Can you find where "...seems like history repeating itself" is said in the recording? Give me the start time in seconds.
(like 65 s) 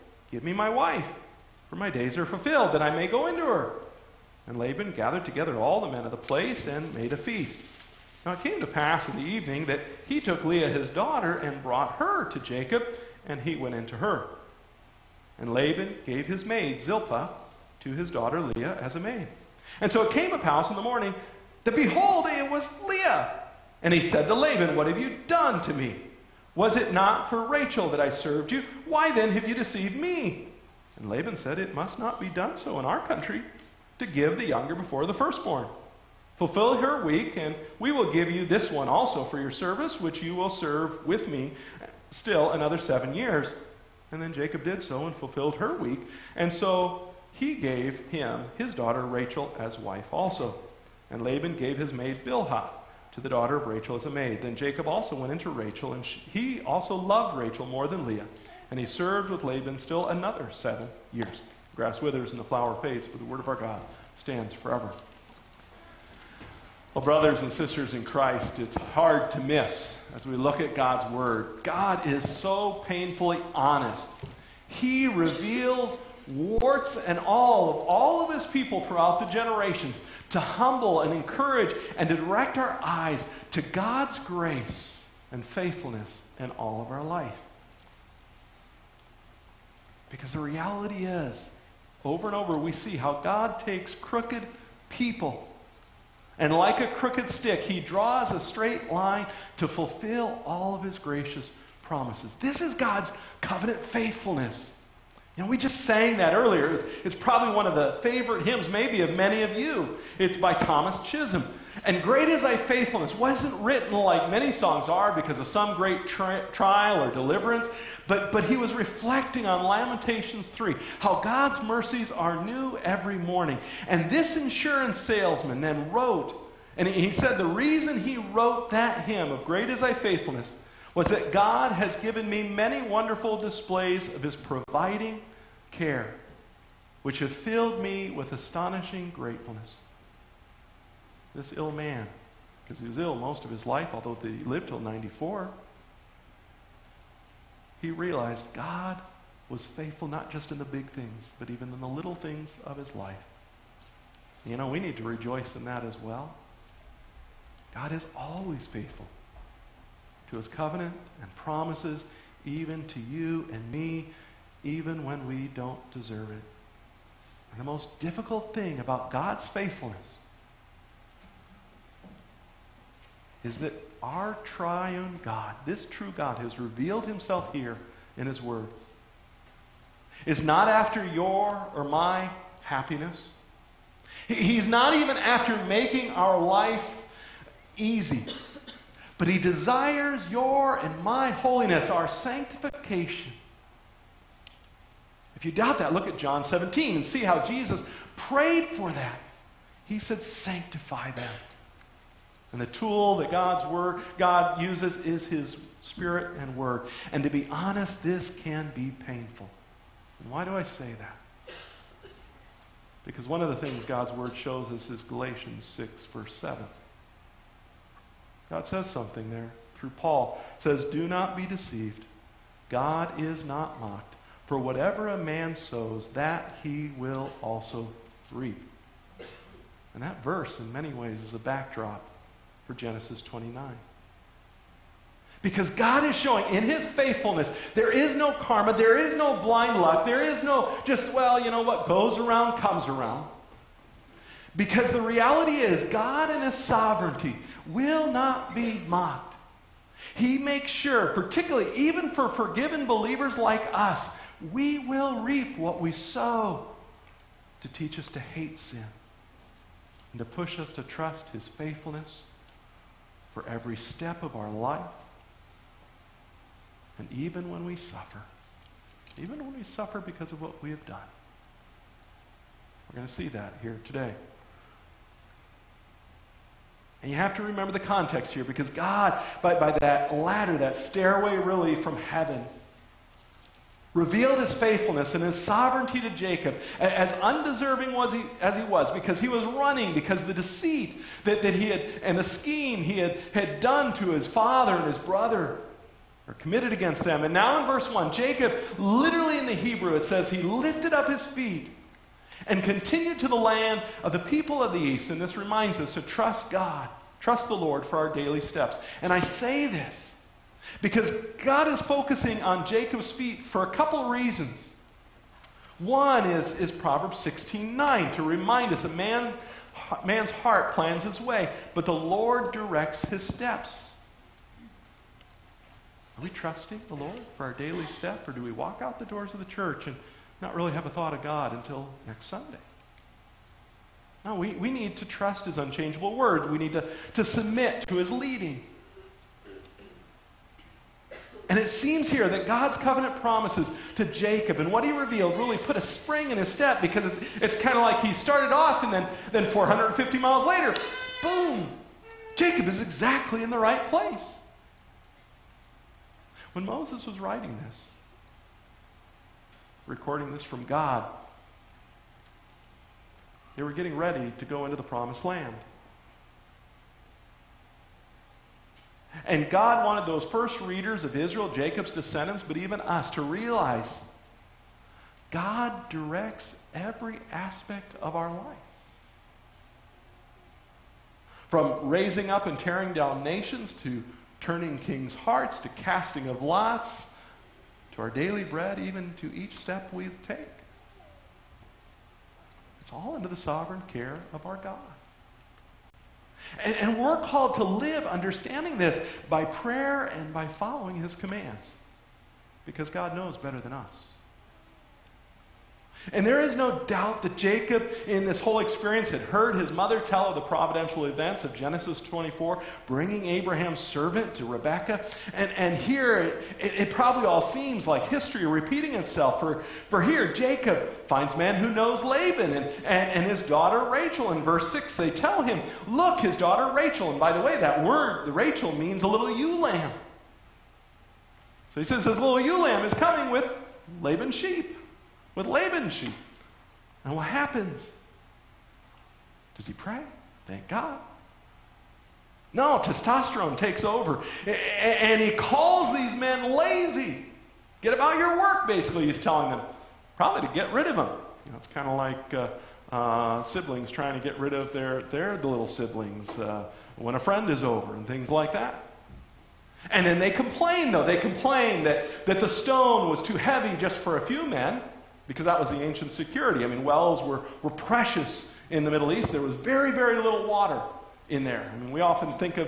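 417 s.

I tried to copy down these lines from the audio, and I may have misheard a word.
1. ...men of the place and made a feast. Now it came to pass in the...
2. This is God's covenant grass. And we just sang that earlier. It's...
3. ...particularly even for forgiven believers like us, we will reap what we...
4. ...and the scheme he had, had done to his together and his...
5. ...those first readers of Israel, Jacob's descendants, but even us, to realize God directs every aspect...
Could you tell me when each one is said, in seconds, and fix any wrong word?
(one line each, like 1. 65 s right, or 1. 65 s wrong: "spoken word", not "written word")
1. 5 s right
2. 102 s wrong: "faithfulness", not "grass"
3. 251 s right
4. 292 s wrong: "father", not "together"
5. 370 s right.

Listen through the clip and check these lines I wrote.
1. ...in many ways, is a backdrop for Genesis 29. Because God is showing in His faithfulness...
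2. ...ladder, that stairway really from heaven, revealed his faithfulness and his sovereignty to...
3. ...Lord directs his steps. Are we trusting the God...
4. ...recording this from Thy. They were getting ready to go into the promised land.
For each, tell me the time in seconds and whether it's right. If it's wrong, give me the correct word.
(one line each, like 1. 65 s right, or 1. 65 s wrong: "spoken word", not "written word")
1. 230 s right
2. 280 s right
3. 321 s wrong: "Lord", not "God"
4. 359 s wrong: "God", not "Thy".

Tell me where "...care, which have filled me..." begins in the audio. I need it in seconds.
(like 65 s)
135 s.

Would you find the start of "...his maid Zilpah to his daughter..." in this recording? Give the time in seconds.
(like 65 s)
16 s.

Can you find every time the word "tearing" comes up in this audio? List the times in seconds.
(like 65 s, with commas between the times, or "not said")
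382 s.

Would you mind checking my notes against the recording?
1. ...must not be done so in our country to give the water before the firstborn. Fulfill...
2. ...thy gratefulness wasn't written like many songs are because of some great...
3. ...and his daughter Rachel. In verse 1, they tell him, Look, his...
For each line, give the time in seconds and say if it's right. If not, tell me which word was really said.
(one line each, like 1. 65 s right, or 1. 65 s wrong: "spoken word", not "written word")
1. 31 s wrong: "younger", not "water"
2. 112 s wrong: "faithfulness", not "gratefulness"
3. 423 s wrong: "6", not "1".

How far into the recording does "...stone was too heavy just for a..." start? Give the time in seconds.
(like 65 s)
462 s.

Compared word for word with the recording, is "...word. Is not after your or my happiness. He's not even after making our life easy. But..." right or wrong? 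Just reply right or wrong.
right.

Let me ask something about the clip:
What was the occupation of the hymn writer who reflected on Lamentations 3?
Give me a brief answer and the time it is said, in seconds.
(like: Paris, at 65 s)
Insurance salesman, at 124 s.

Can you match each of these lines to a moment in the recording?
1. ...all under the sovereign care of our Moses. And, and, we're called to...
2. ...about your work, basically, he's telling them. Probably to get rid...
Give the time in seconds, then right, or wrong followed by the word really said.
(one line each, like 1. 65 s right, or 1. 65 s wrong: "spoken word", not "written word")
1. 392 s wrong: "God", not "Moses"
2. 447 s right.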